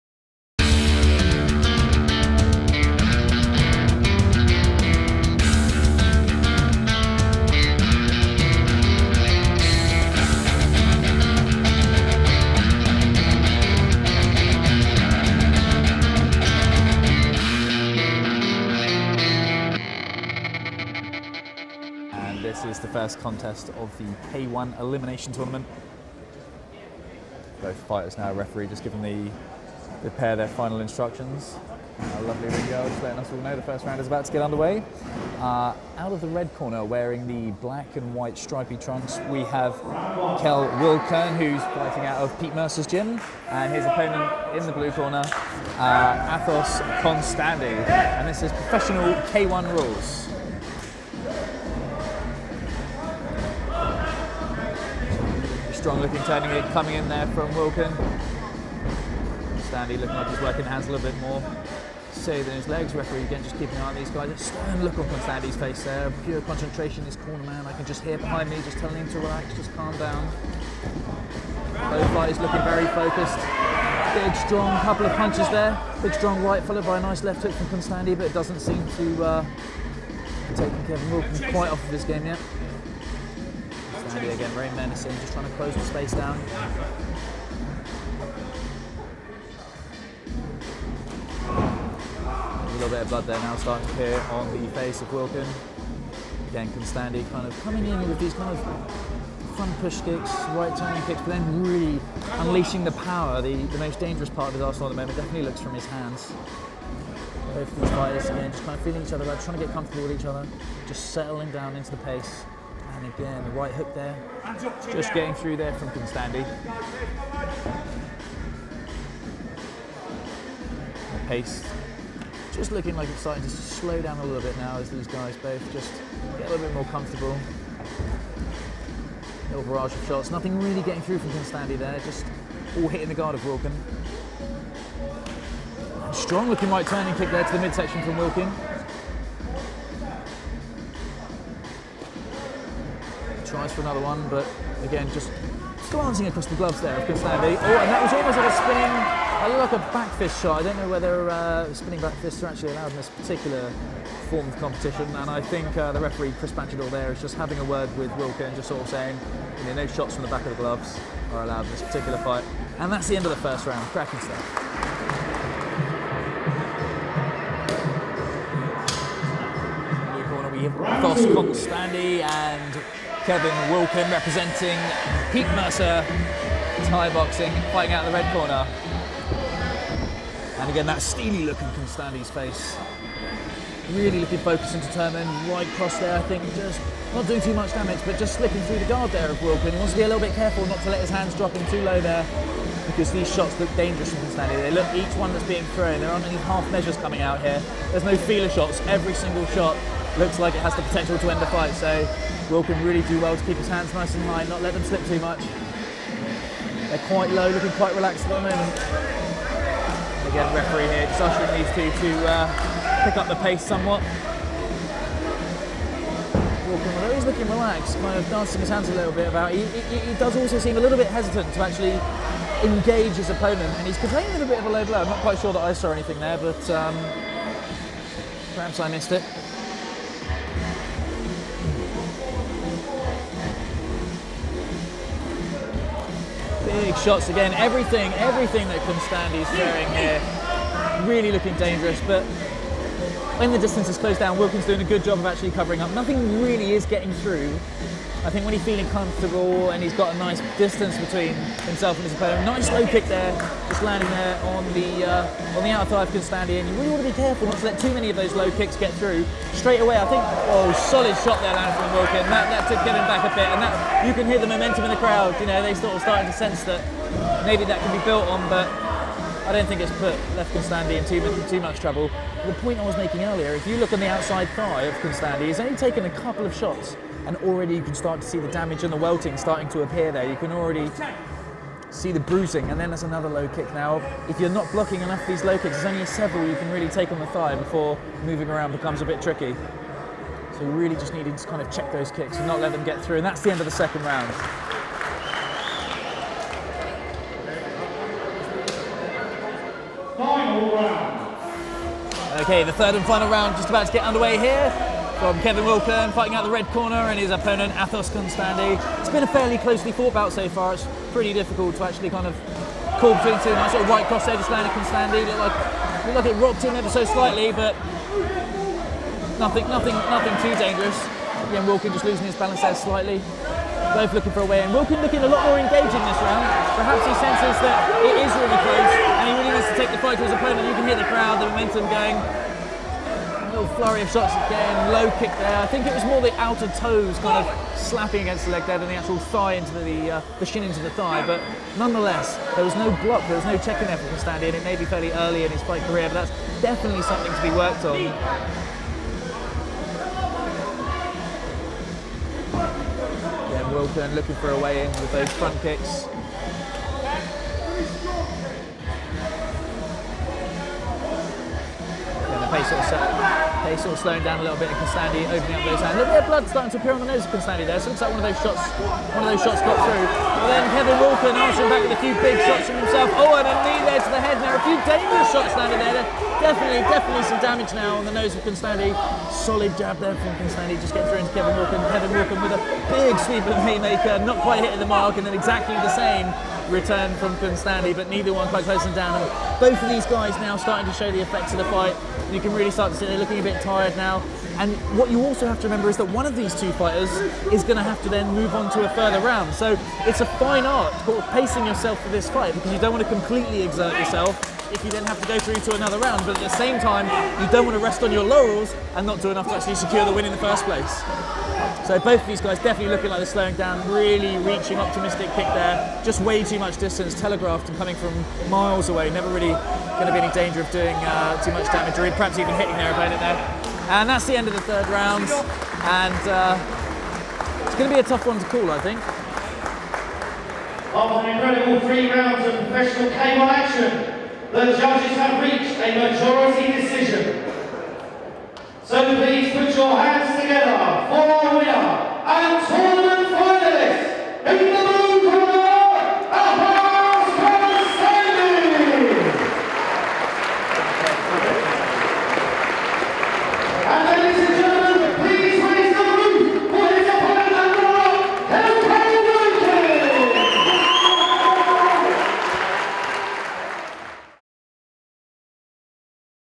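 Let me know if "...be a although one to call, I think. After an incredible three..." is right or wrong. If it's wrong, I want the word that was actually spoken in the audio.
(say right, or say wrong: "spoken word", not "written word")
wrong: "tough", not "although".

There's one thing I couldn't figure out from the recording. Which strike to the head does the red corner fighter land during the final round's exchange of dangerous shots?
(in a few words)
A knee.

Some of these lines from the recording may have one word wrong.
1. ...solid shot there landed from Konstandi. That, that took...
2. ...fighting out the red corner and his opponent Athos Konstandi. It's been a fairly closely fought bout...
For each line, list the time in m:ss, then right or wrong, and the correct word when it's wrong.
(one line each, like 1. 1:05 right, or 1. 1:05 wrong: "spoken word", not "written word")
1. 4:20 wrong: "Wilkin", not "Konstandi"
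2. 5:06 right.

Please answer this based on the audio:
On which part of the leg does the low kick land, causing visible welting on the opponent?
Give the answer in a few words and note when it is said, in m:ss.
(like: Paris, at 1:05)
Outer thigh, at 4:15.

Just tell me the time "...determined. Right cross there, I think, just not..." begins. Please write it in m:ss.
3:04.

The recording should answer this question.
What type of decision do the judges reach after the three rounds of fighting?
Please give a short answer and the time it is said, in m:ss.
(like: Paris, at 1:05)
Majority decision, at 7:15.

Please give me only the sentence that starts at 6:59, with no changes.
Never really going to be any danger of doing uh, too much damage or perhaps even hitting their opponent there.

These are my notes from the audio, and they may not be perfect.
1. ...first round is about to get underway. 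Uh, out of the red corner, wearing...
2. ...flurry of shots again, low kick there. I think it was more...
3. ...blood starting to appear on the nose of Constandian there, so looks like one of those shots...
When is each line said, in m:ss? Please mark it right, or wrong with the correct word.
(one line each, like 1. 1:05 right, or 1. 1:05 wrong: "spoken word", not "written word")
1. 0:33 right
2. 5:33 right
3. 6:06 wrong: "Konstandi", not "Constandian".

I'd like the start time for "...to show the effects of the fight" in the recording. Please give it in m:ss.
6:30.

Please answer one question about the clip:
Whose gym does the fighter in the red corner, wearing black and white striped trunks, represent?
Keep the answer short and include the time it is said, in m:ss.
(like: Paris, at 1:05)
Pete Mercer's gym, at 0:42.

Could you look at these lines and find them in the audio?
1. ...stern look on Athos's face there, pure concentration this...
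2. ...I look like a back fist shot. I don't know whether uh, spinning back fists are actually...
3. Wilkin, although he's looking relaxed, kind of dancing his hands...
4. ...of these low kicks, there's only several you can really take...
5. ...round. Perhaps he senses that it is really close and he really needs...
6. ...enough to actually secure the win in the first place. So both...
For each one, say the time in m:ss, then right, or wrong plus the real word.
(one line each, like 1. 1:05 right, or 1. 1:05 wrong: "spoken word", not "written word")
1. 1:04 wrong: "Stanley", not "Athos"
2. 2:28 right
3. 3:36 right
4. 4:45 right
5. 5:26 right
6. 6:49 right.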